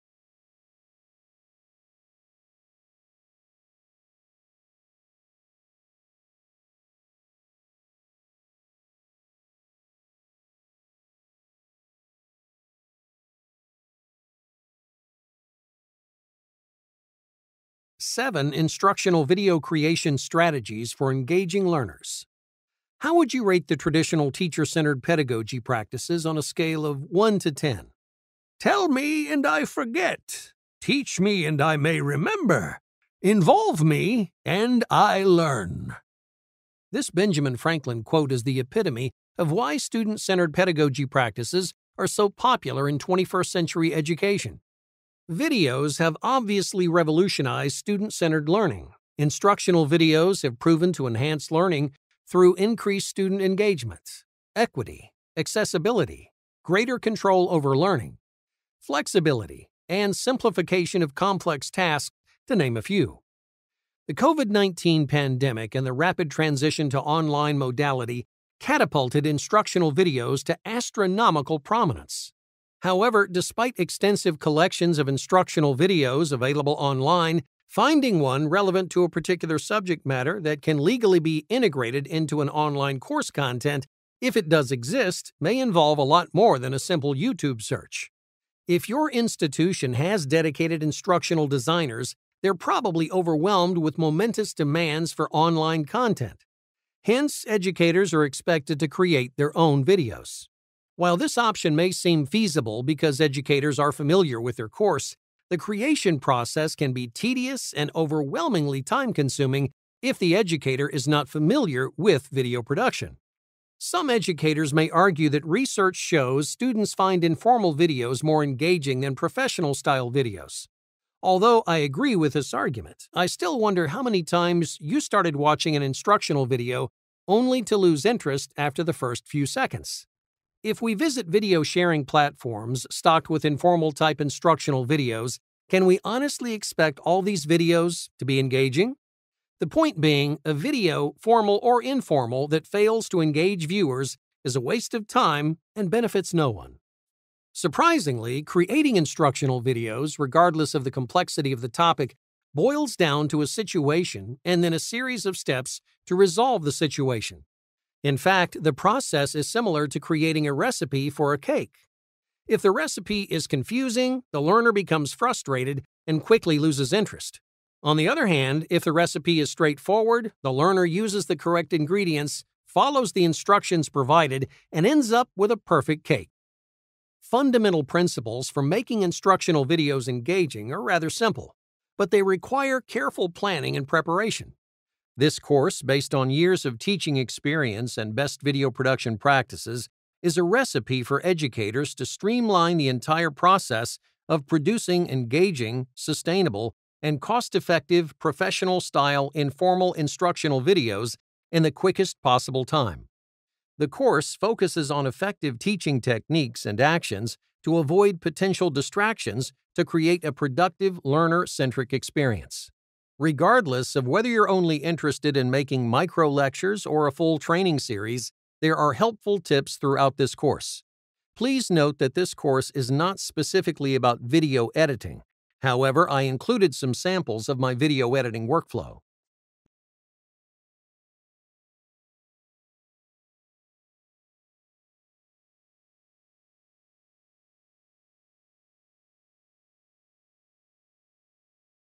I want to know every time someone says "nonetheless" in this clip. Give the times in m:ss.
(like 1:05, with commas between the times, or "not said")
not said.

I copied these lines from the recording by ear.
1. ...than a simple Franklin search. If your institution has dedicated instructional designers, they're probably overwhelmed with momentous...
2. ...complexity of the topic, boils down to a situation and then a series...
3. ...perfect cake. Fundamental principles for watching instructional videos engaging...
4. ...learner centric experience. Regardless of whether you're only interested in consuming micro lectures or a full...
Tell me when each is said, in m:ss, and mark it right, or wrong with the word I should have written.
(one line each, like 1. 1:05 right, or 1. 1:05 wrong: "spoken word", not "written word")
1. 1:26 wrong: "YouTube", not "Franklin"
2. 2:30 right
3. 2:55 wrong: "making", not "watching"
4. 3:31 wrong: "making", not "consuming".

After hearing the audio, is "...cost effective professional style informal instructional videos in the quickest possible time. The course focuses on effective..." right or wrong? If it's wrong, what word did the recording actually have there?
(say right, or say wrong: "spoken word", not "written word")
right.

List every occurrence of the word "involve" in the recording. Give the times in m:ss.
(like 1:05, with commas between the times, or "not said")
0:33, 1:25.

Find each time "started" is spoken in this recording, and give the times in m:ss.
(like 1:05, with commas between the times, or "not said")
2:04.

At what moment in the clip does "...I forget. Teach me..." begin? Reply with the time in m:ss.
0:29.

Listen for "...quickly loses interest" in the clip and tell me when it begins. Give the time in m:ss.
2:46.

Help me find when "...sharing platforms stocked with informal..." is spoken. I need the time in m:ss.
2:11.